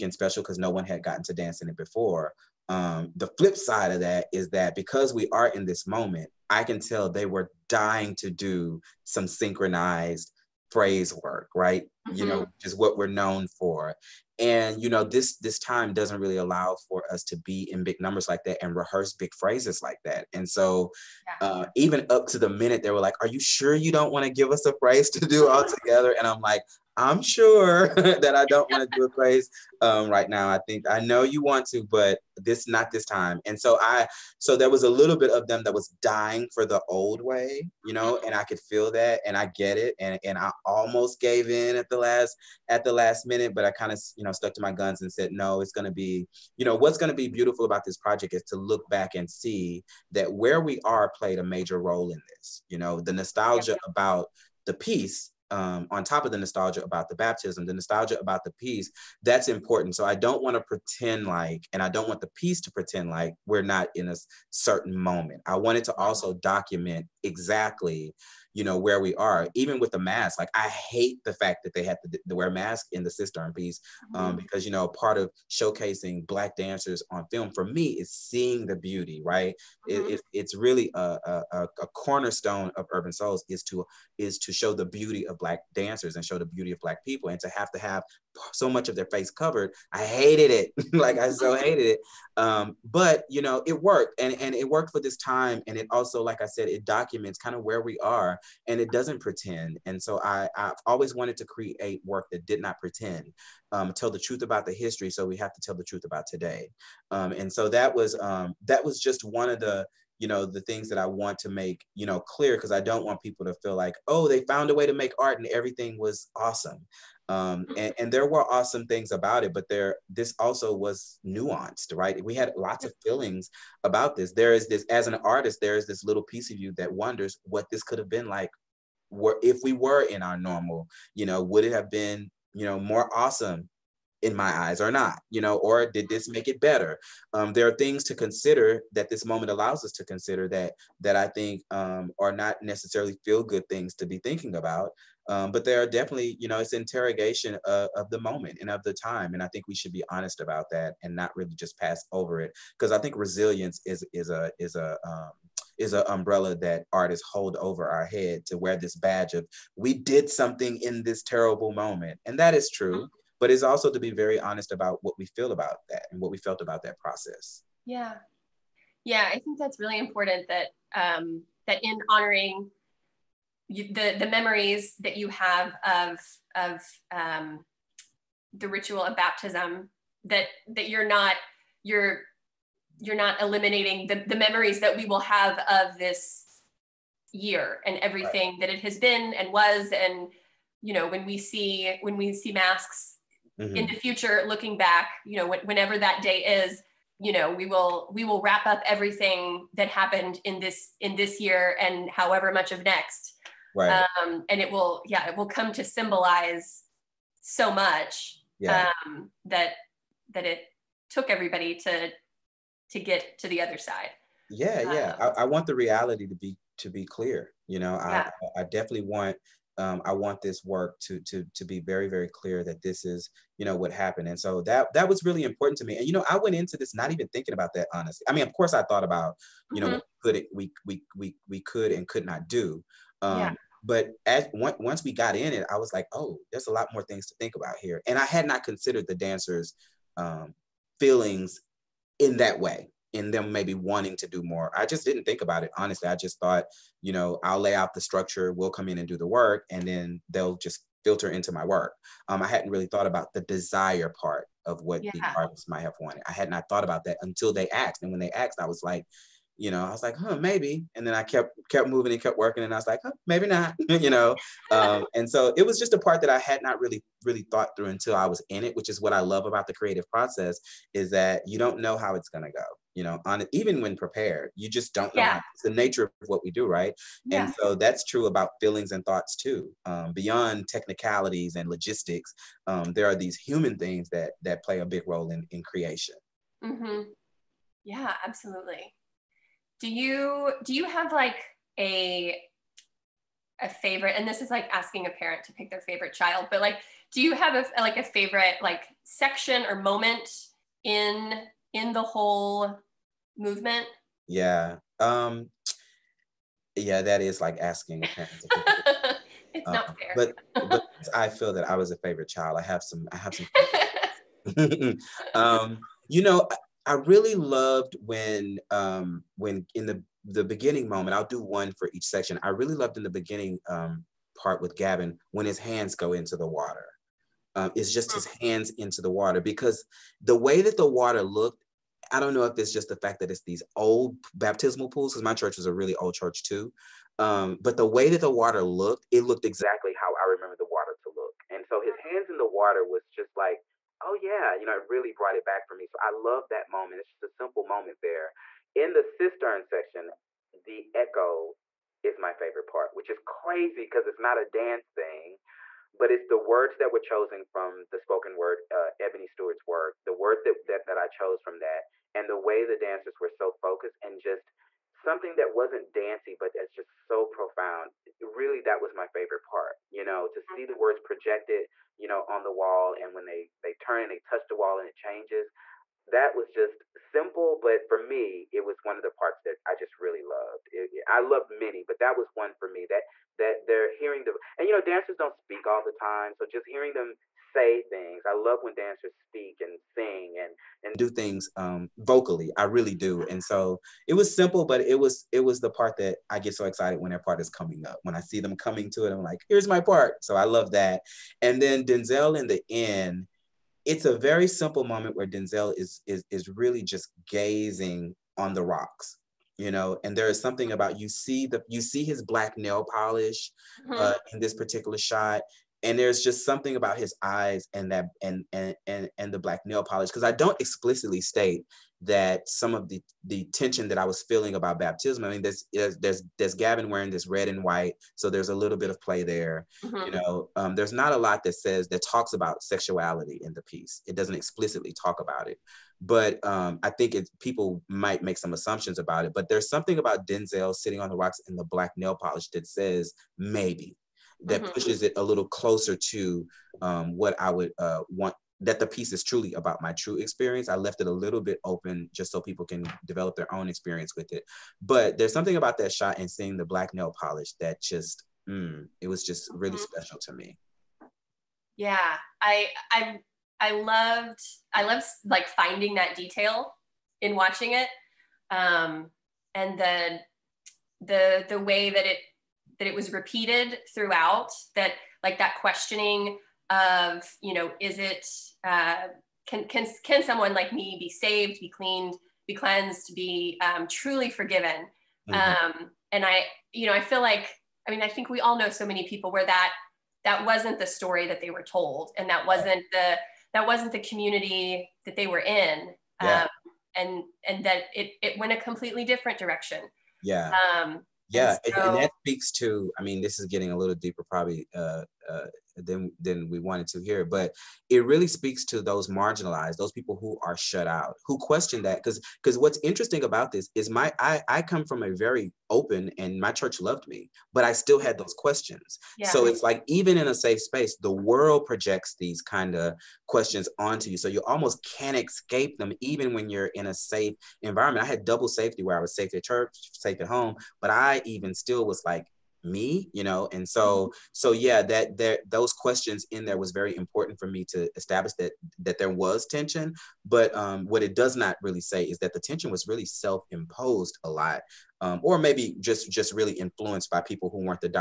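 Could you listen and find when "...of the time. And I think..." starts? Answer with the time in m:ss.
2:28.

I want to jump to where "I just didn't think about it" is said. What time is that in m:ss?
4:04.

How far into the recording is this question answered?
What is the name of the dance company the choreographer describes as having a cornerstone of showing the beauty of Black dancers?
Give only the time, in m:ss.
1:22.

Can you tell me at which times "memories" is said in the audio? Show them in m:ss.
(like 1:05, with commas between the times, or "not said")
2:54, 3:04.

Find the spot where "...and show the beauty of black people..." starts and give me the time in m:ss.
1:26.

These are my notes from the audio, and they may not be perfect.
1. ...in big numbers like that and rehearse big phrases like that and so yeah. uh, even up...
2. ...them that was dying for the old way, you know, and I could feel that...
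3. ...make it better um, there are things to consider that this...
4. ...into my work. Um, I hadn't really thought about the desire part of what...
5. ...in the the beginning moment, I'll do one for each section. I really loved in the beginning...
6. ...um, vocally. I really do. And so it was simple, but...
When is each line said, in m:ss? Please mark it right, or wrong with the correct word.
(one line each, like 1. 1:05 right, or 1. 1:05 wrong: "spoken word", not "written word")
1. 0:17 right
2. 0:35 right
3. 2:16 right
4. 4:11 right
5. 5:19 right
6. 6:31 right.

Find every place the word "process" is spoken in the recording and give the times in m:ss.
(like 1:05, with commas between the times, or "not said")
2:46, 4:30.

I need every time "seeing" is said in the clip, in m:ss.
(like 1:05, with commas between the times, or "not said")
1:18, 7:36.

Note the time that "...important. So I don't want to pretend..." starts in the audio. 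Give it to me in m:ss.
0:59.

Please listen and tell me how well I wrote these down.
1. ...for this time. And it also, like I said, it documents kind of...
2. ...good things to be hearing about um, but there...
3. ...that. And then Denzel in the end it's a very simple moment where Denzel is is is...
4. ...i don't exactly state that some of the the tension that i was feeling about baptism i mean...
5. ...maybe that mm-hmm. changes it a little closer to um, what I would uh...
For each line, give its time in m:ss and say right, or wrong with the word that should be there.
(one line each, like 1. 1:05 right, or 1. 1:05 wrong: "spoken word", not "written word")
1. 1:34 right
2. 2:23 wrong: "thinking", not "hearing"
3. 6:40 right
4. 7:00 wrong: "explicitly", not "exactly"
5. 7:23 wrong: "pushes", not "changes".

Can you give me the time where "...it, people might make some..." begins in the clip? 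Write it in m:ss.
7:17.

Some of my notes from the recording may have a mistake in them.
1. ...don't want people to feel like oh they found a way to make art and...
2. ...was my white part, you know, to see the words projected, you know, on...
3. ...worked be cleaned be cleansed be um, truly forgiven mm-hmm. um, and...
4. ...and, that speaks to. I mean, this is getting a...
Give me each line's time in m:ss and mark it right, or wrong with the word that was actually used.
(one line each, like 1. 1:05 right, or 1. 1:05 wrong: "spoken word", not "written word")
1. 1:52 right
2. 6:08 wrong: "favorite", not "white"
3. 8:01 wrong: "saved", not "worked"
4. 8:21 right.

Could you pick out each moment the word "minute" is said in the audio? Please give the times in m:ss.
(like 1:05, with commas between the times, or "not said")
0:22, 0:43.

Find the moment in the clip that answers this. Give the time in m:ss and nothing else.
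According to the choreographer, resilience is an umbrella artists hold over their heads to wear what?
2:38.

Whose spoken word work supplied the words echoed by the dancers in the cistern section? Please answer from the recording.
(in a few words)
Ebony Stewart.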